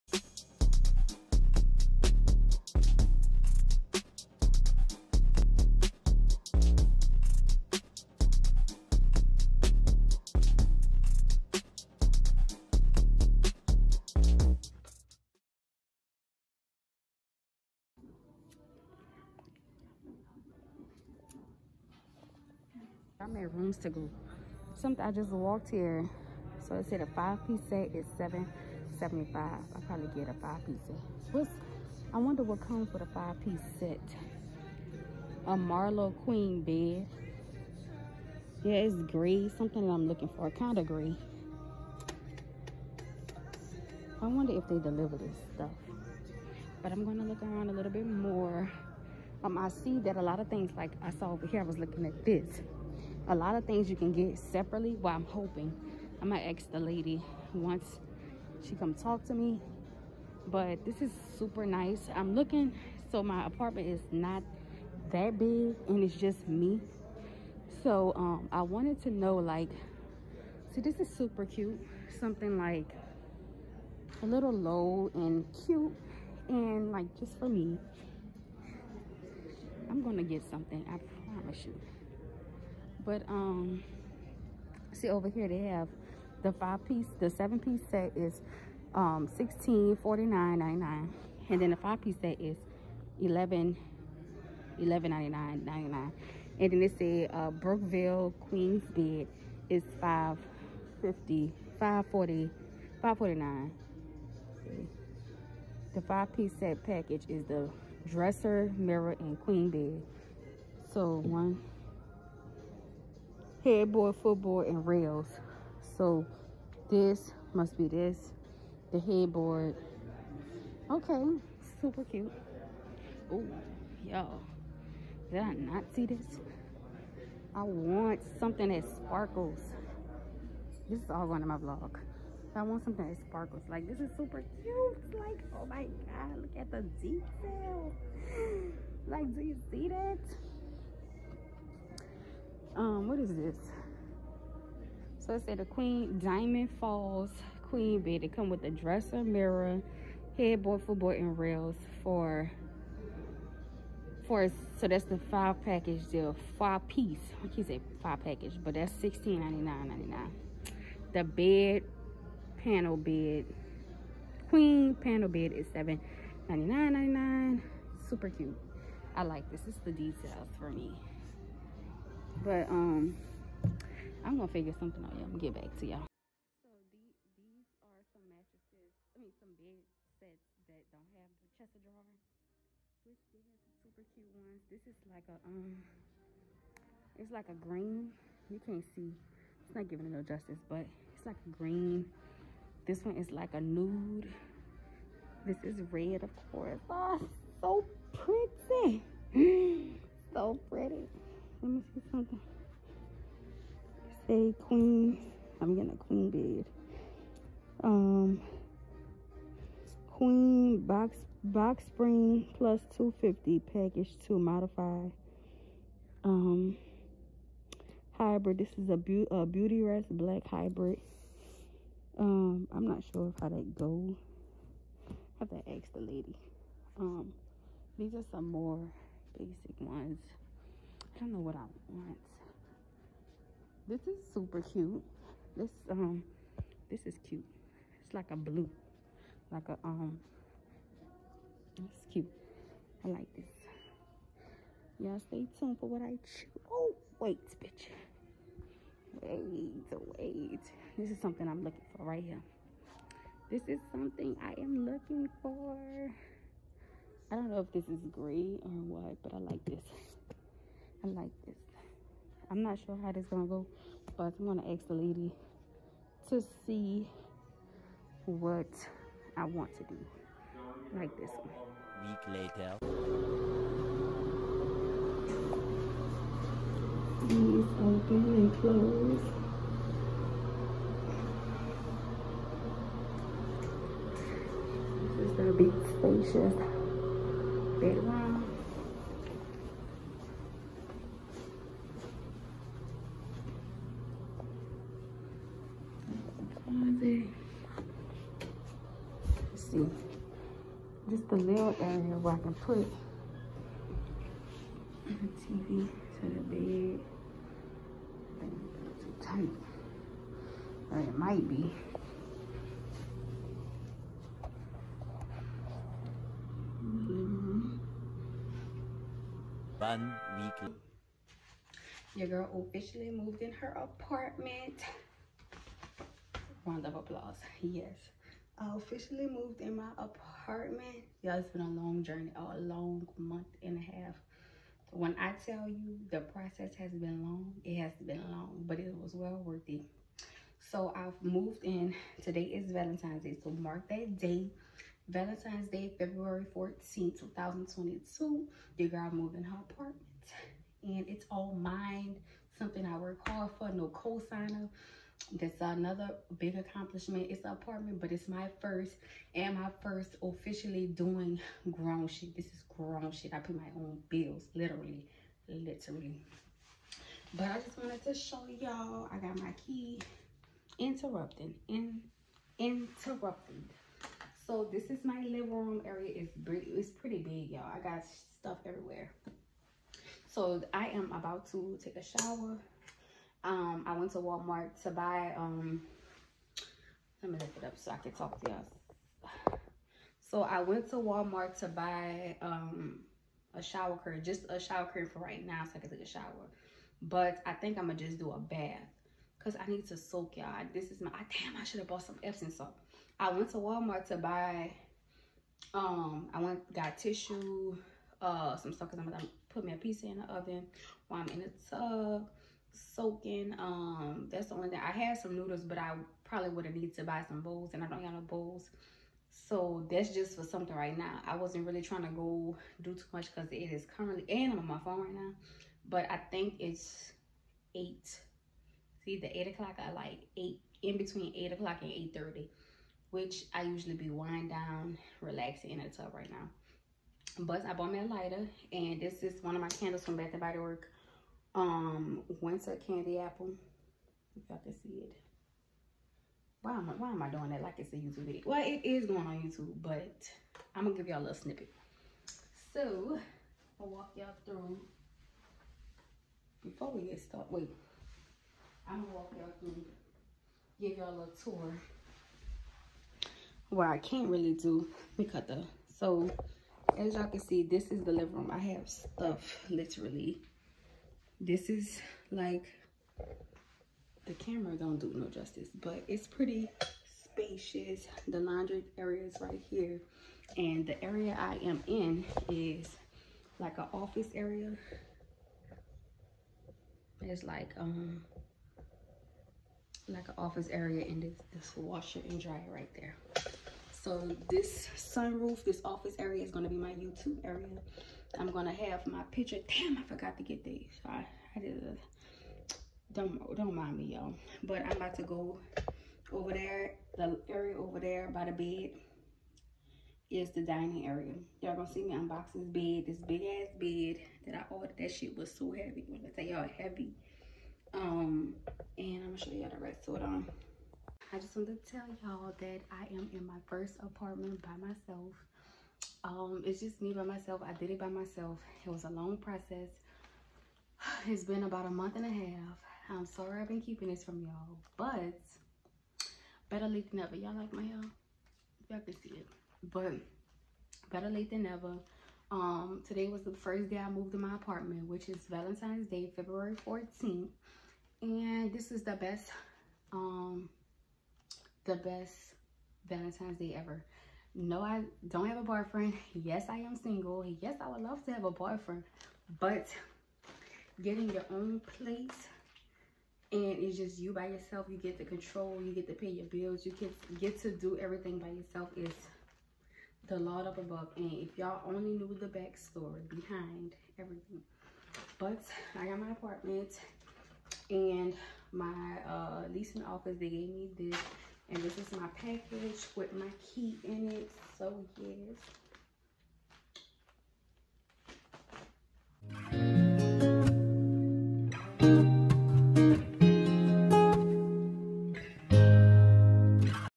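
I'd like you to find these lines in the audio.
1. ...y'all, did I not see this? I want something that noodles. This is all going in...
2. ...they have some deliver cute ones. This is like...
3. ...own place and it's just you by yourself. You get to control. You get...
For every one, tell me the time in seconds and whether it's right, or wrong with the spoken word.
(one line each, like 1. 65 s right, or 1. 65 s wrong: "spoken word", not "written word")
1. 124 s wrong: "sparkles", not "noodles"
2. 183 s wrong: "super", not "deliver"
3. 561 s right.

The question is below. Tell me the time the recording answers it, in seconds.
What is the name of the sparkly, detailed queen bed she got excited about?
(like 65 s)
146 s.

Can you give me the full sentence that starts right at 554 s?
No, I don't have a boyfriend.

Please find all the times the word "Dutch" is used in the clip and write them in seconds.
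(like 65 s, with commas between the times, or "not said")
not said.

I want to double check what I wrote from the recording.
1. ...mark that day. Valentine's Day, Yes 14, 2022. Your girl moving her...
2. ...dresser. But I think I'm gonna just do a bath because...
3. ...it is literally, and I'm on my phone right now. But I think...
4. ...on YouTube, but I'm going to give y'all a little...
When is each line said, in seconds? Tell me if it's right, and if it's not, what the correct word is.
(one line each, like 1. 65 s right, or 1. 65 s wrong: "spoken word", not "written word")
1. 343 s wrong: "February", not "Yes"
2. 396 s wrong: "shower", not "dresser"
3. 423 s wrong: "currently", not "literally"
4. 449 s right.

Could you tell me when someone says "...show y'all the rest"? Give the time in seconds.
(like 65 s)
519 s.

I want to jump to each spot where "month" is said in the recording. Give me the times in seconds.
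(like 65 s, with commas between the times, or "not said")
333 s, 531 s.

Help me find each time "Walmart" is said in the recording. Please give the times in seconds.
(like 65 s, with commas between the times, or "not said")
384 s, 390 s, 403 s.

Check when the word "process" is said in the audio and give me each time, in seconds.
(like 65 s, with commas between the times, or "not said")
336 s, 529 s.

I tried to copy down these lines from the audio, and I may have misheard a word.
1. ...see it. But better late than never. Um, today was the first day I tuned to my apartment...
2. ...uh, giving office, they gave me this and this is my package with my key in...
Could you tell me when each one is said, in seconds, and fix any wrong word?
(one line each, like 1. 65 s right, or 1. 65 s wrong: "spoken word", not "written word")
1. 539 s wrong: "moved", not "tuned"
2. 579 s wrong: "leasing", not "giving".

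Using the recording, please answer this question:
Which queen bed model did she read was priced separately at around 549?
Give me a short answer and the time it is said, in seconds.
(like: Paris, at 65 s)
Brookville, at 97 s.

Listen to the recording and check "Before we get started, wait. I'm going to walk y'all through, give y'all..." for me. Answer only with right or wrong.
right.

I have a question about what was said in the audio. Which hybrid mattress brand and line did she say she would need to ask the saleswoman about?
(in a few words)
Beautyrest Black.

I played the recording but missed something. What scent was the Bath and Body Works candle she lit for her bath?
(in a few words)
Winter Candy Apple.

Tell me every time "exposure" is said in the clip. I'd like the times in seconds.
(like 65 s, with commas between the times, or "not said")
not said.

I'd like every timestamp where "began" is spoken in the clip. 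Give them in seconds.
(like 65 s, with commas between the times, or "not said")
not said.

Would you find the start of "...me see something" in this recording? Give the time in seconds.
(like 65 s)
201 s.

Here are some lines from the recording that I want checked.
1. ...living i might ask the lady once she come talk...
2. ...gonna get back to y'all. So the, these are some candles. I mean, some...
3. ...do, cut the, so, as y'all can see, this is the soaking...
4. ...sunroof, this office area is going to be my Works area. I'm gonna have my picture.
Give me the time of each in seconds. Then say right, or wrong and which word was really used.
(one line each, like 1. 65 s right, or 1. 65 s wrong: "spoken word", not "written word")
1. 55 s wrong: "hoping", not "living"
2. 175 s wrong: "mattresses", not "candles"
3. 464 s wrong: "living", not "soaking"
4. 494 s wrong: "YouTube", not "Works".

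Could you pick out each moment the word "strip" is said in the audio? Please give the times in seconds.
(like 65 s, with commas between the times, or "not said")
not said.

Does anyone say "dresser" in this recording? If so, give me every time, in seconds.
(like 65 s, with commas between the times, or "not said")
108 s, 148 s.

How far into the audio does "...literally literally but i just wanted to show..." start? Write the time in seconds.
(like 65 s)
364 s.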